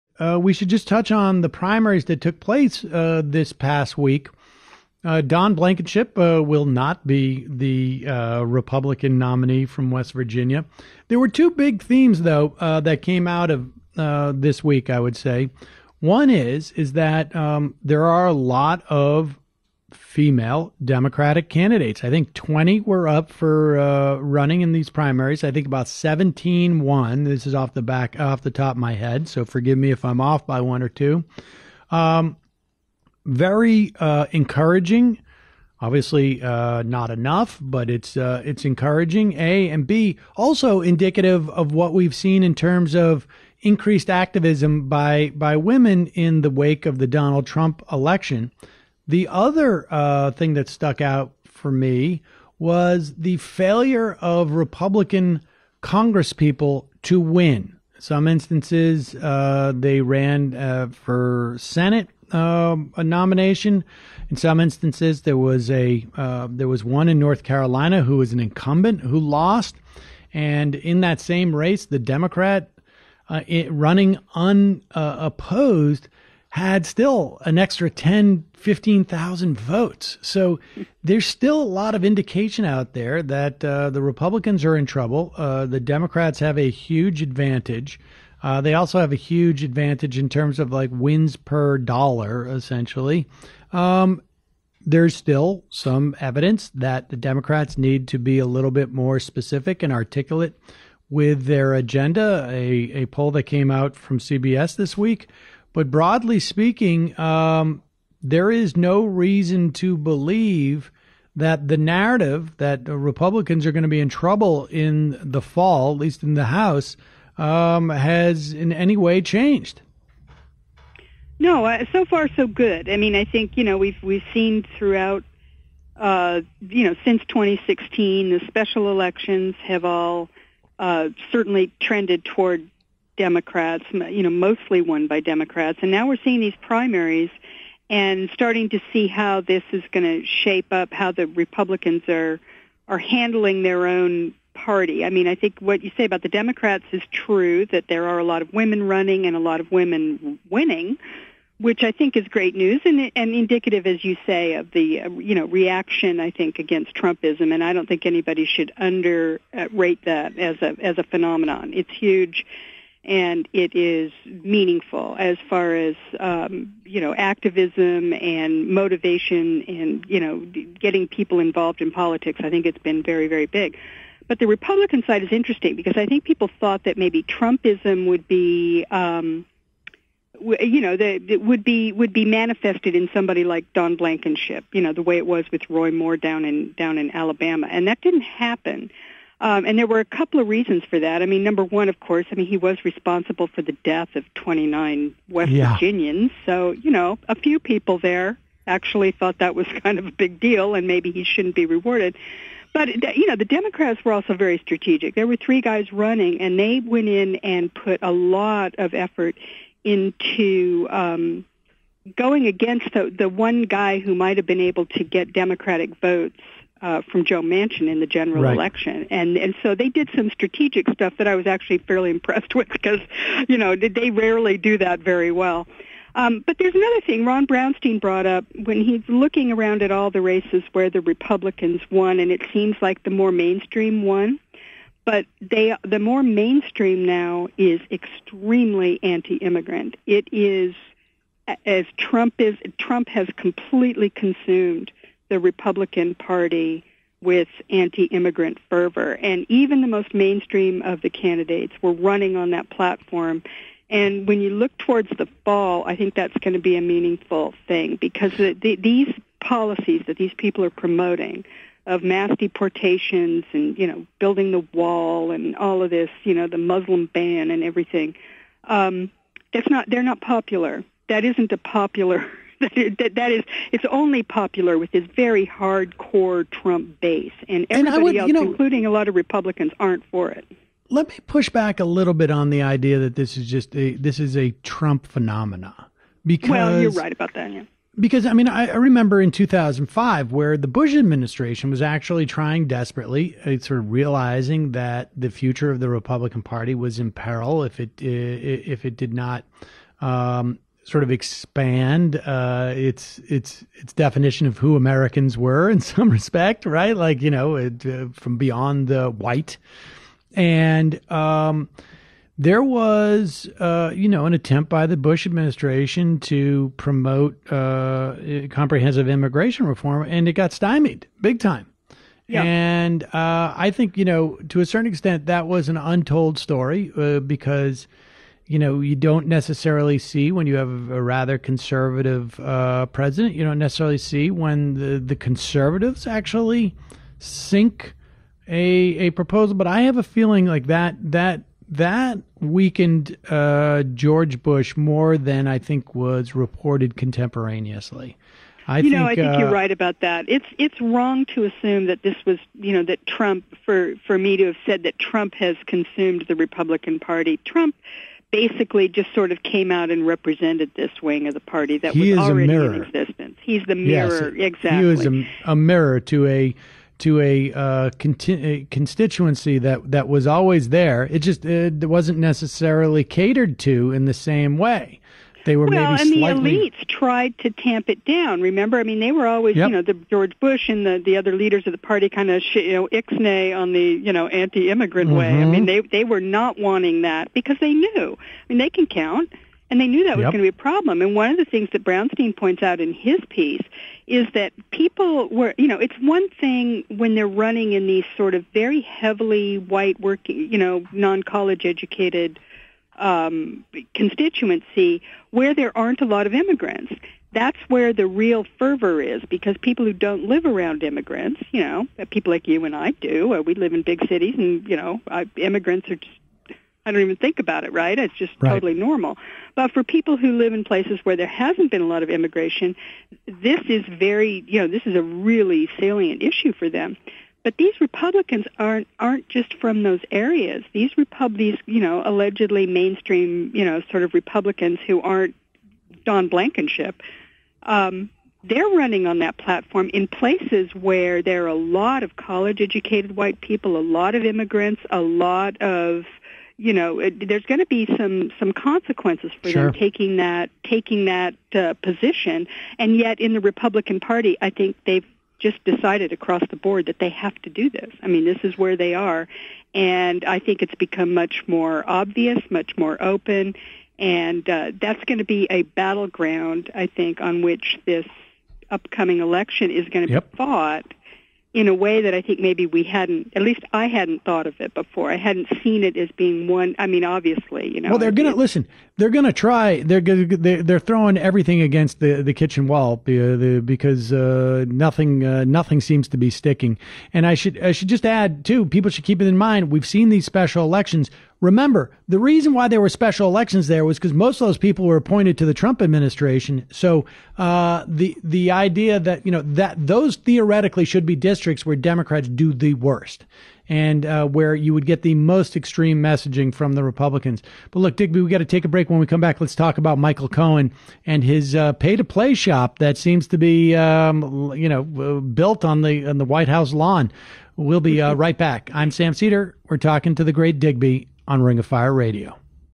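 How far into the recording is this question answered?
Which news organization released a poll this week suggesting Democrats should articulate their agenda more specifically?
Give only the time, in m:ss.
1:44.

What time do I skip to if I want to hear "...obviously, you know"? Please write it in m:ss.
7:57.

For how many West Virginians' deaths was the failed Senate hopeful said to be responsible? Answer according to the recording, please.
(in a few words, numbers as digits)
29.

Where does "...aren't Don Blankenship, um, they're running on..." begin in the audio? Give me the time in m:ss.
7:15.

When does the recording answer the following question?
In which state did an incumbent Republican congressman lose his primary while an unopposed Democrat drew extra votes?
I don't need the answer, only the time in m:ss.
1:07.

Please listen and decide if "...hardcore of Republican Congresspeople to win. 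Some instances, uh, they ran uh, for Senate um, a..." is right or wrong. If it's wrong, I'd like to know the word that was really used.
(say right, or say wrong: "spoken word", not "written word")
wrong: "failure", not "hardcore".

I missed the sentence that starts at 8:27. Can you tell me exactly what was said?
But look, Digby, we got to take a break.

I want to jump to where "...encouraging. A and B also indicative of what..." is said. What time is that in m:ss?
0:38.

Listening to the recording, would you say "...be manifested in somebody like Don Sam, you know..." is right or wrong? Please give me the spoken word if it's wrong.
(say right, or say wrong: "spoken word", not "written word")
wrong: "Blankenship", not "Sam".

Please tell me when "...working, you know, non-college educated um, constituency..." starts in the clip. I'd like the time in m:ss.
6:39.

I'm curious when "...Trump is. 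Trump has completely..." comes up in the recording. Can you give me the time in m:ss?
4:01.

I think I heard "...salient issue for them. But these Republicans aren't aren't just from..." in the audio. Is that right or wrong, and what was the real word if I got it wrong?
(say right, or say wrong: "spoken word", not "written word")
right.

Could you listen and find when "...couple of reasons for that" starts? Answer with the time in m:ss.
3:10.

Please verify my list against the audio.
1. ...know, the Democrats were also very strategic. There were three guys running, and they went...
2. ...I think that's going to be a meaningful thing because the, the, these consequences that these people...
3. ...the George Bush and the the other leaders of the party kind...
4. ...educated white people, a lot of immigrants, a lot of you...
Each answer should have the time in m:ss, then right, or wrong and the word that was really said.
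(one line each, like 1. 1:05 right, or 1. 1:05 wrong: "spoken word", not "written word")
1. 3:23 right
2. 4:15 wrong: "policies", not "consequences"
3. 6:19 right
4. 7:22 right.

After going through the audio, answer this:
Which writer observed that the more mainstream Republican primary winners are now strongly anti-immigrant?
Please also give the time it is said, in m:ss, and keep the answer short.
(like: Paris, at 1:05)
Ron Brownstein, at 3:47.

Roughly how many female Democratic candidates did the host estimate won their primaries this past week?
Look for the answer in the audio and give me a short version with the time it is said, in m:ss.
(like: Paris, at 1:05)
17, at 0:25.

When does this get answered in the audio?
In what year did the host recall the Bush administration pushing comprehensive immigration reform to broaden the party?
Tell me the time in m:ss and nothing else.
4:49.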